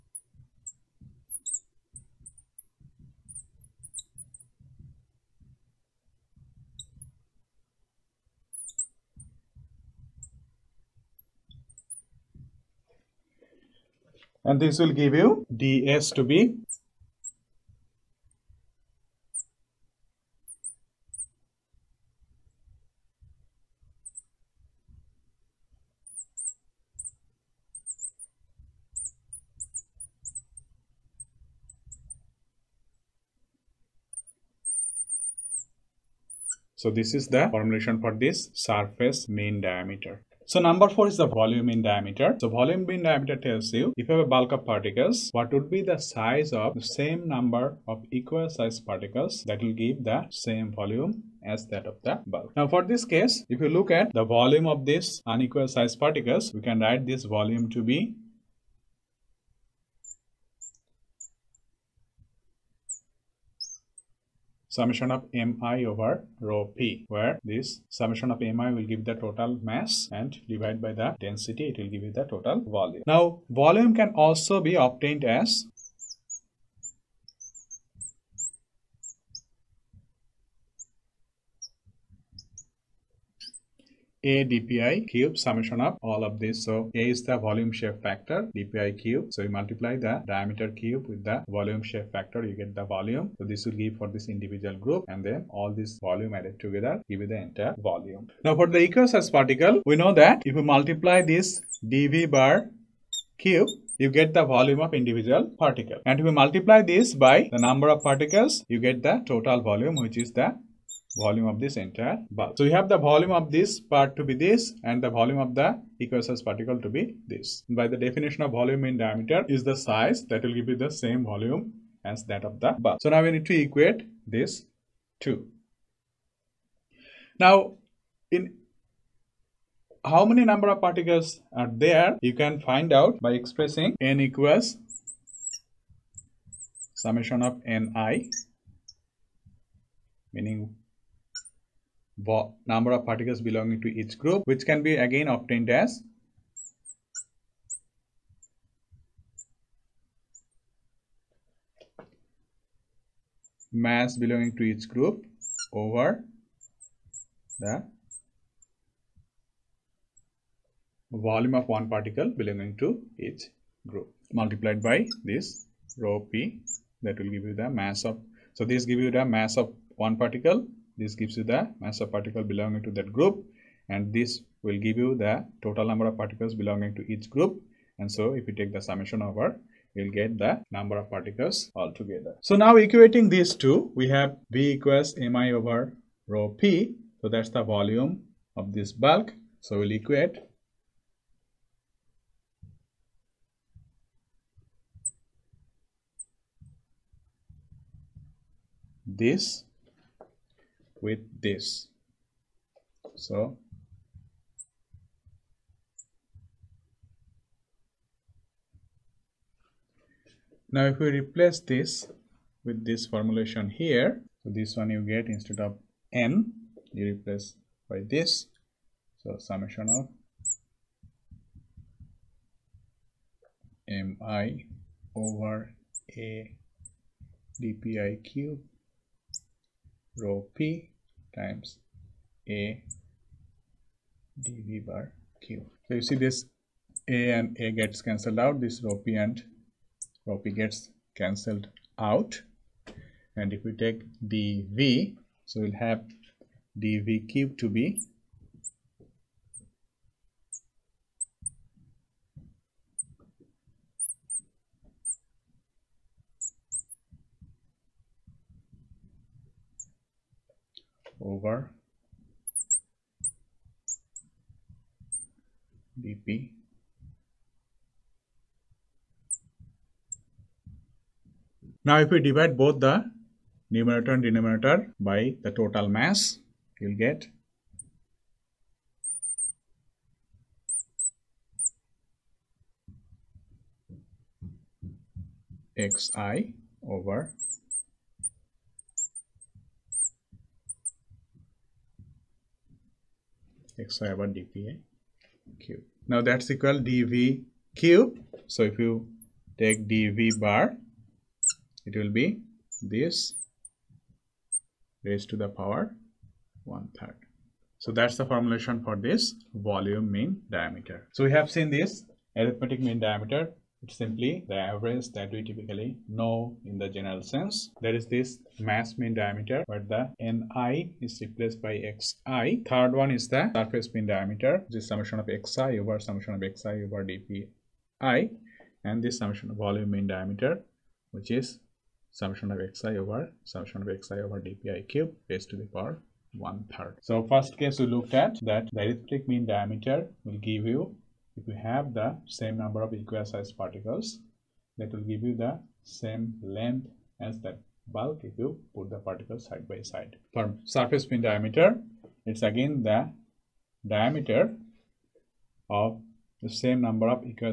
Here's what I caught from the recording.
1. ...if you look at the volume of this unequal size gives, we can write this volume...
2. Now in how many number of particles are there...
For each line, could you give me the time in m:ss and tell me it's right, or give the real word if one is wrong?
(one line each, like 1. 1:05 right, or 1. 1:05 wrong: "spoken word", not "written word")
1. 0:53 wrong: "particles", not "gives"
2. 2:07 right.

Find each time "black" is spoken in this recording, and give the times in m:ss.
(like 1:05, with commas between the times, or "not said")
not said.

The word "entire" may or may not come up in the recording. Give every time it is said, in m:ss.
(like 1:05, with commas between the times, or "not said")
1:37, 1:51.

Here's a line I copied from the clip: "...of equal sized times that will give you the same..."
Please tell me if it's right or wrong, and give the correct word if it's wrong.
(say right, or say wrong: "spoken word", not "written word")
wrong: "particles", not "times".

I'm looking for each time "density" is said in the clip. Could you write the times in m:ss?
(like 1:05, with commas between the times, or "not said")
1:11.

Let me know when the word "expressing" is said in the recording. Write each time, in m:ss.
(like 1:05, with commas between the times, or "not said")
2:13.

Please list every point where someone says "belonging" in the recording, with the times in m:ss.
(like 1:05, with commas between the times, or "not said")
2:23, 2:34, 2:42, 2:52, 2:56.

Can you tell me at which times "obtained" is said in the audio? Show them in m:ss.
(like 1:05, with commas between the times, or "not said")
1:14, 2:25.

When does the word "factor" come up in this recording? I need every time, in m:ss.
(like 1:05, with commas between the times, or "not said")
1:28, 1:32.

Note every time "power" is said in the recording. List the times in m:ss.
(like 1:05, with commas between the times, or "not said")
5:05, 5:35.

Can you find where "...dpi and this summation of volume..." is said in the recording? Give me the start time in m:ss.
5:27.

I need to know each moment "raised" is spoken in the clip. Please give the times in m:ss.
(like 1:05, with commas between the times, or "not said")
5:05, 5:35.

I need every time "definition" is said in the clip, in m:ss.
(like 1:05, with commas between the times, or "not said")
1:57.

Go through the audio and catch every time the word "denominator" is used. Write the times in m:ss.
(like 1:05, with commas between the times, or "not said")
4:34.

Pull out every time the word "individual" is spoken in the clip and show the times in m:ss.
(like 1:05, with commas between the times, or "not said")
1:34, 1:45.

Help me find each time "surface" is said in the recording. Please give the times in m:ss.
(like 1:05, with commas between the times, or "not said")
0:38, 5:23, 5:50.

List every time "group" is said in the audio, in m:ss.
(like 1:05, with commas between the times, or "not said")
1:34, 2:24, 2:34, 2:43, 2:53, 2:57.